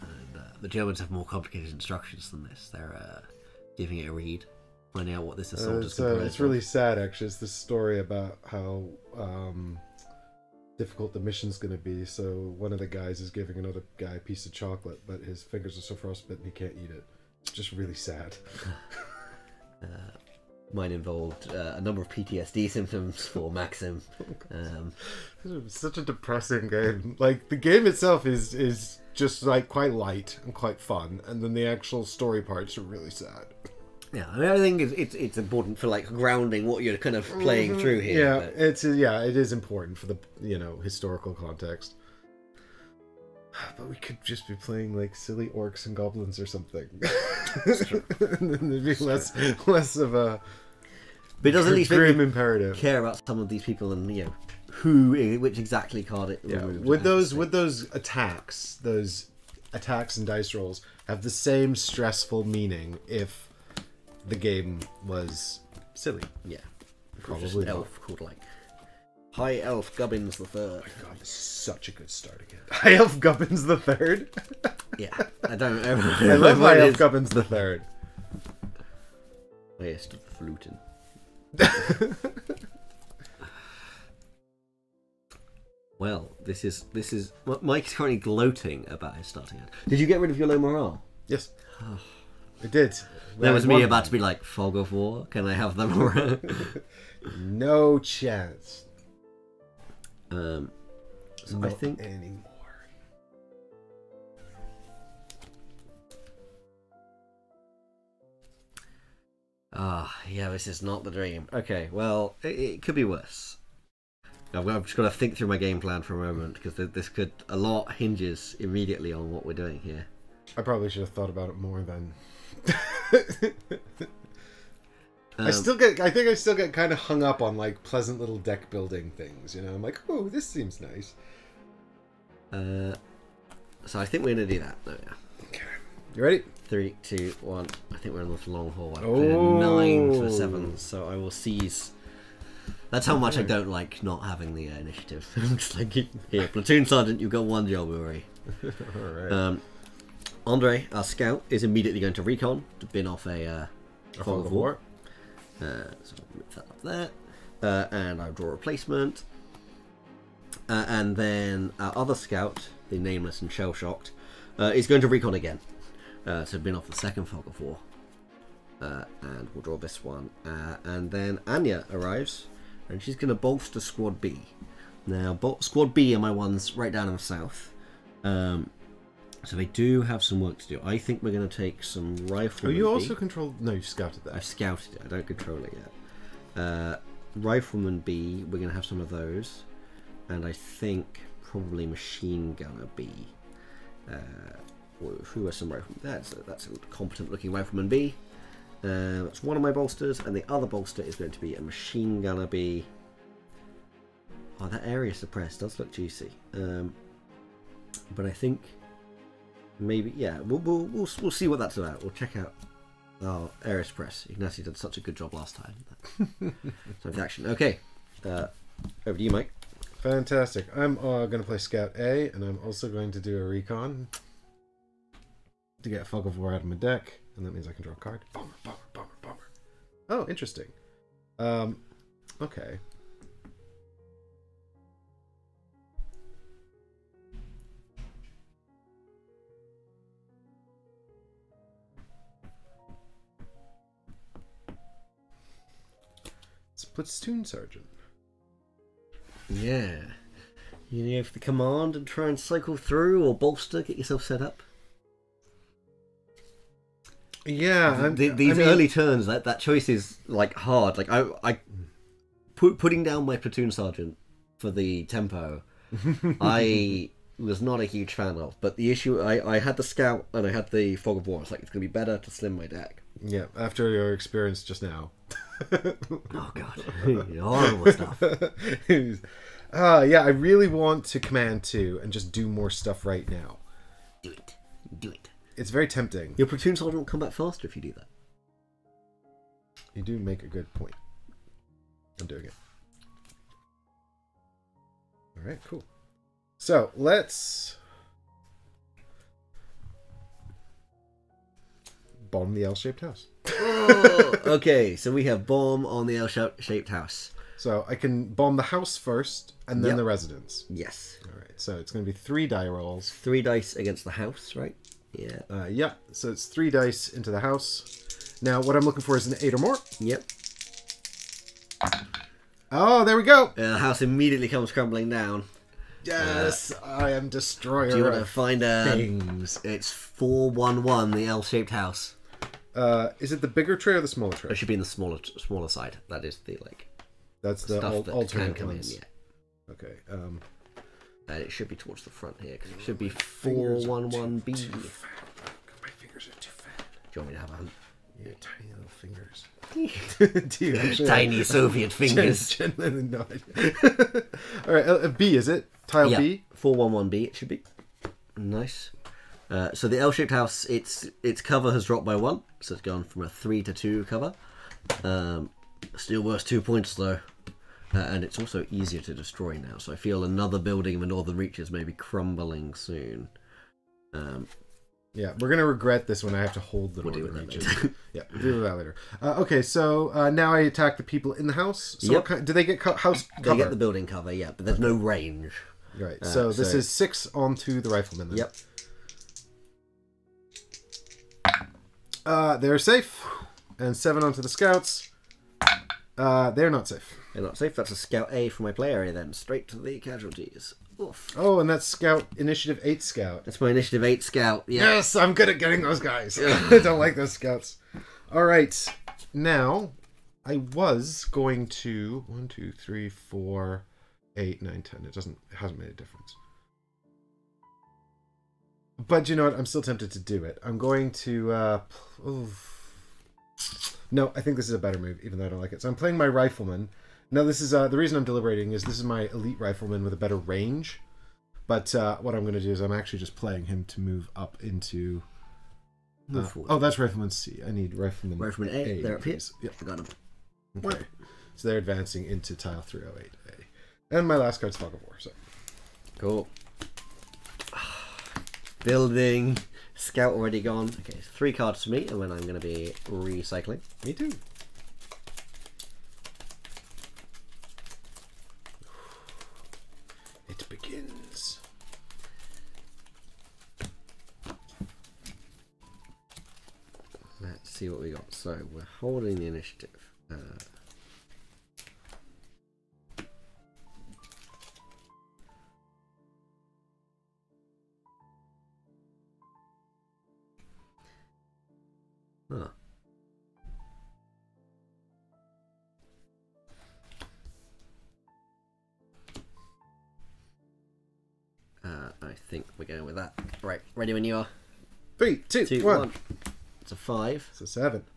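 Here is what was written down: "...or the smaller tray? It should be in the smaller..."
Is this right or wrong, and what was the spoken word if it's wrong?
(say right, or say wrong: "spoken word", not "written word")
right.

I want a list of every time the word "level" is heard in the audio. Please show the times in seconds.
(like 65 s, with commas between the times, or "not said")
not said.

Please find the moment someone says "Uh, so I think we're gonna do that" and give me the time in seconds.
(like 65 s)
132 s.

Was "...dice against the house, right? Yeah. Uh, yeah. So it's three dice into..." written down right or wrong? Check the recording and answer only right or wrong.
right.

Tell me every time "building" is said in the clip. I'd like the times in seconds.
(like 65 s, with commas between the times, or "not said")
128 s, 370 s, 383 s, 448 s.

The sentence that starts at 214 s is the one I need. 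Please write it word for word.
Ignacio did such a good job last time.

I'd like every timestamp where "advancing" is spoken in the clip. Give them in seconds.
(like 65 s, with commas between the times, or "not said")
441 s.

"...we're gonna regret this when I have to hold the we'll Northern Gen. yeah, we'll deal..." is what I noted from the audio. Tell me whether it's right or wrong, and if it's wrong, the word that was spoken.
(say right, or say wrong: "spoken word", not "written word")
wrong: "Reaches", not "Gen".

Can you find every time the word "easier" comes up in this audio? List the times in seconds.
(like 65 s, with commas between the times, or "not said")
368 s.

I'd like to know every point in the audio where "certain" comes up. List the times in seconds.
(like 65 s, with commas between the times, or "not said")
not said.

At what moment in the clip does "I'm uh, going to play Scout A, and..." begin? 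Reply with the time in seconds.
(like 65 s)
220 s.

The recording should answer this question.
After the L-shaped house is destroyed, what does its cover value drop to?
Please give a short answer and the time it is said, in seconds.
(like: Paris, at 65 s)
2, at 363 s.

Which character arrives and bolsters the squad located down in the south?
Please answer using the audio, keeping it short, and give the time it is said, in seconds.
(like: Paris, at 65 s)
Anya, at 171 s.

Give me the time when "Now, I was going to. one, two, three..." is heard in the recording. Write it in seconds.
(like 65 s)
409 s.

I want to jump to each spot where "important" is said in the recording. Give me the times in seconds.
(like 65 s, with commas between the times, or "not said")
35 s, 39 s.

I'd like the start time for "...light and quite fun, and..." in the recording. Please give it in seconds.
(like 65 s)
29 s.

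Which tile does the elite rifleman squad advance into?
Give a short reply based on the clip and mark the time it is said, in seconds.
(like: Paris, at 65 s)
308A, at 442 s.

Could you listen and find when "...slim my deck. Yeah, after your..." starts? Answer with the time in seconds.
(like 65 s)
272 s.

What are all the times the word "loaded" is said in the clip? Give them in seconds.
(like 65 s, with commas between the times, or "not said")
not said.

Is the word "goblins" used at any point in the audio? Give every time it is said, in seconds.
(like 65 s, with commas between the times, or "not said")
45 s.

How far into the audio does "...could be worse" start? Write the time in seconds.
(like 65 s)
112 s.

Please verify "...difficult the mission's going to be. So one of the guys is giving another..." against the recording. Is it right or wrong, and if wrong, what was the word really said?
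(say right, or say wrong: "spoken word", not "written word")
right.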